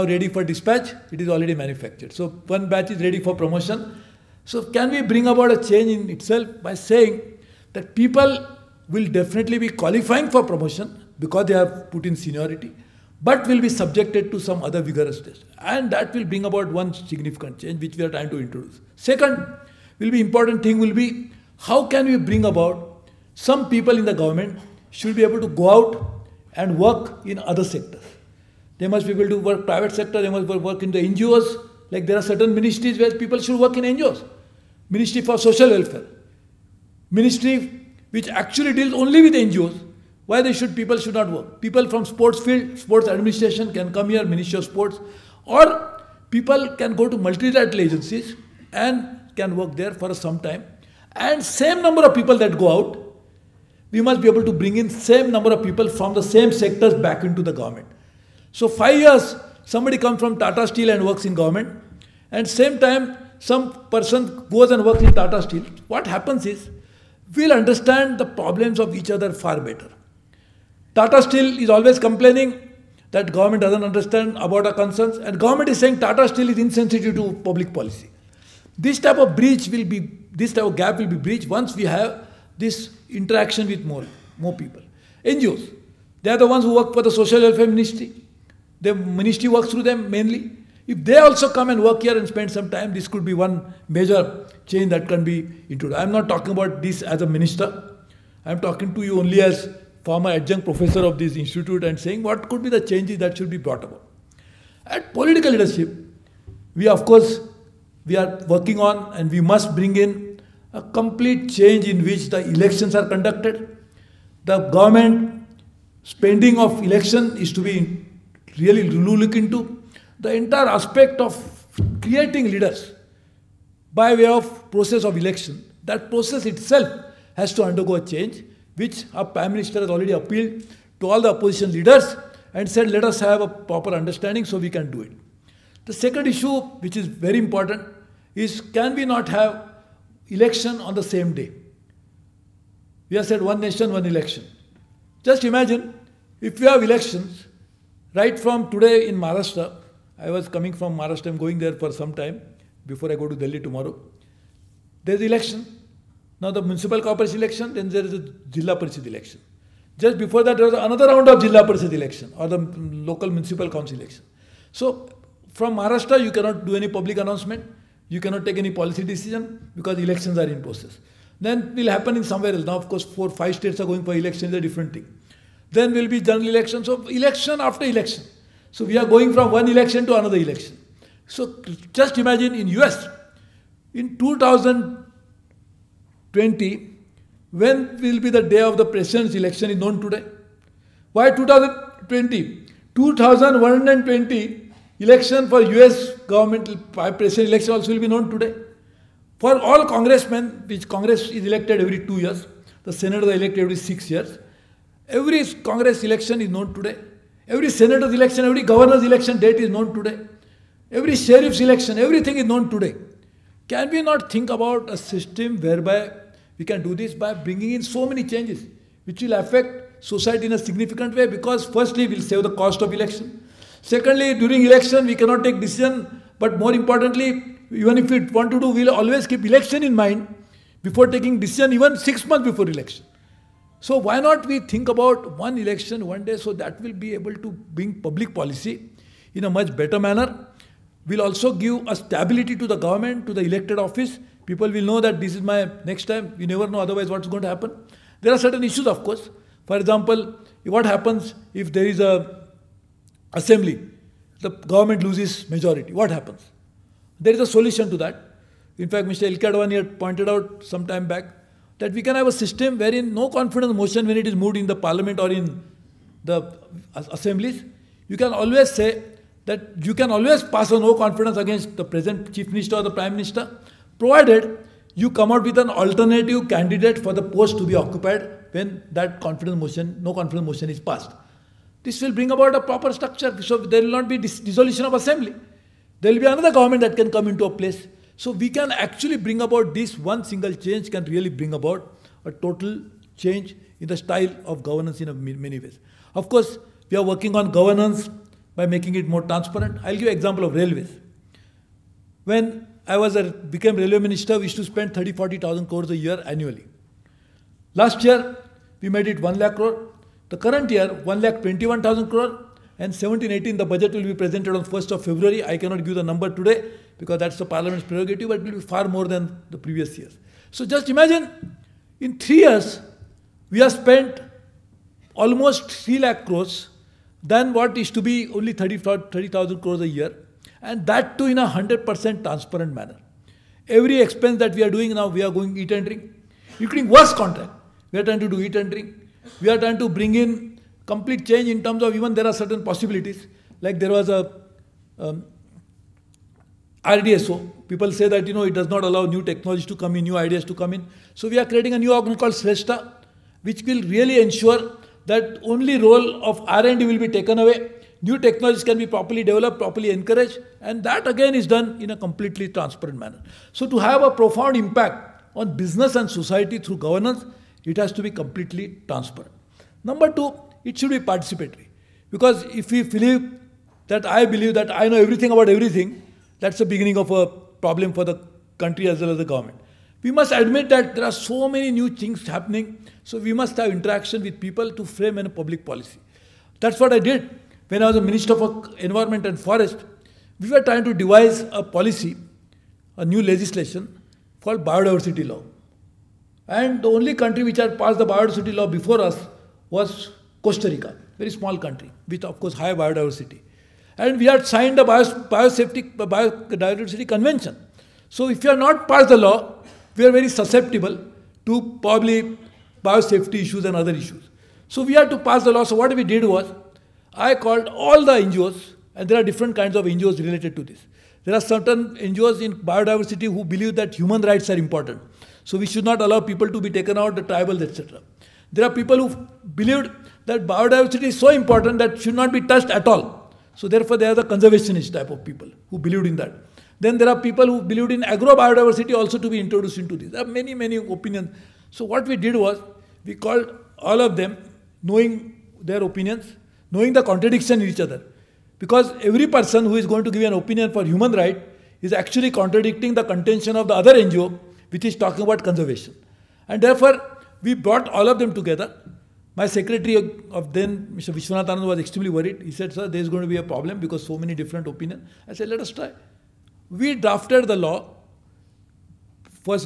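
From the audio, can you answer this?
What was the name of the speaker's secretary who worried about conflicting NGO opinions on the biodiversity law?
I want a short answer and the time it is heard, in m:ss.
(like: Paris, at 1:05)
Mr. Vishwanathan, at 7:40.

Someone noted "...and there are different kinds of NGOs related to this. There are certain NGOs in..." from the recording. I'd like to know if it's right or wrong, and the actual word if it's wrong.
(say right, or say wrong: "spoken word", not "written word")
right.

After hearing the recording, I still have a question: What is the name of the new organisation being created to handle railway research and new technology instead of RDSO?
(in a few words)
SRESTHA.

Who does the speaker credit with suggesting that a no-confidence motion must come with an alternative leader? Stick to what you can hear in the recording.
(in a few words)
Mr. 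Ilka.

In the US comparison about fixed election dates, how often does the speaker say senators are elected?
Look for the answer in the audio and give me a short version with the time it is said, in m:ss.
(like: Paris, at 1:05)
every 6 years, at 3:23.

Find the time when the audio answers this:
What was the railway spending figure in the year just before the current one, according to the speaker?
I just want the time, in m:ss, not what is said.
5:09.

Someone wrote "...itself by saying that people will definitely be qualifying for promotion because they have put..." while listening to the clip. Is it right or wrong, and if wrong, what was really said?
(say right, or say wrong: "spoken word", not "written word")
right.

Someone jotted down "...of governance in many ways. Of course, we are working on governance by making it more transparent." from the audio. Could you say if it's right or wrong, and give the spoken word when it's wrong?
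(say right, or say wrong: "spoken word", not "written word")
right.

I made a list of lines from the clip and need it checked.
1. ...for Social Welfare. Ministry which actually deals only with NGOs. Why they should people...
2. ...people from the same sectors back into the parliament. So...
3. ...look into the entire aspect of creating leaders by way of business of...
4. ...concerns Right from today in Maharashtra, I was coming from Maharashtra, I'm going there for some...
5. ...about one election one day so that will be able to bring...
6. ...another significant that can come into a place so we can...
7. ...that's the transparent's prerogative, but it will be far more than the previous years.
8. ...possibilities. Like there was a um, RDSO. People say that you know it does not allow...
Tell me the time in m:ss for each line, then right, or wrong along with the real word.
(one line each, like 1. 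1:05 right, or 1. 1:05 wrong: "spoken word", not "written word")
1. 0:35 right
2. 0:55 wrong: "government", not "parliament"
3. 1:58 wrong: "process", not "business"
4. 2:26 wrong: "elections", not "concerns"
5. 3:54 right
6. 4:46 wrong: "government", not "significant"
7. 5:17 wrong: "parliament", not "transparent"
8. 5:42 right.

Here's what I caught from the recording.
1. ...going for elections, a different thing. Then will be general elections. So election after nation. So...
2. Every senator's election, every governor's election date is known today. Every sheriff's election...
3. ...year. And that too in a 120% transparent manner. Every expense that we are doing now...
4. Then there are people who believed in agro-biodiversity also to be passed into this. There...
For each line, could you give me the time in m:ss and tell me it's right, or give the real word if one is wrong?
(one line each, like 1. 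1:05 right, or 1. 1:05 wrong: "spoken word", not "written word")
1. 2:53 wrong: "election", not "nation"
2. 3:27 right
3. 5:29 wrong: "100", not "120"
4. 7:16 wrong: "introduced", not "passed".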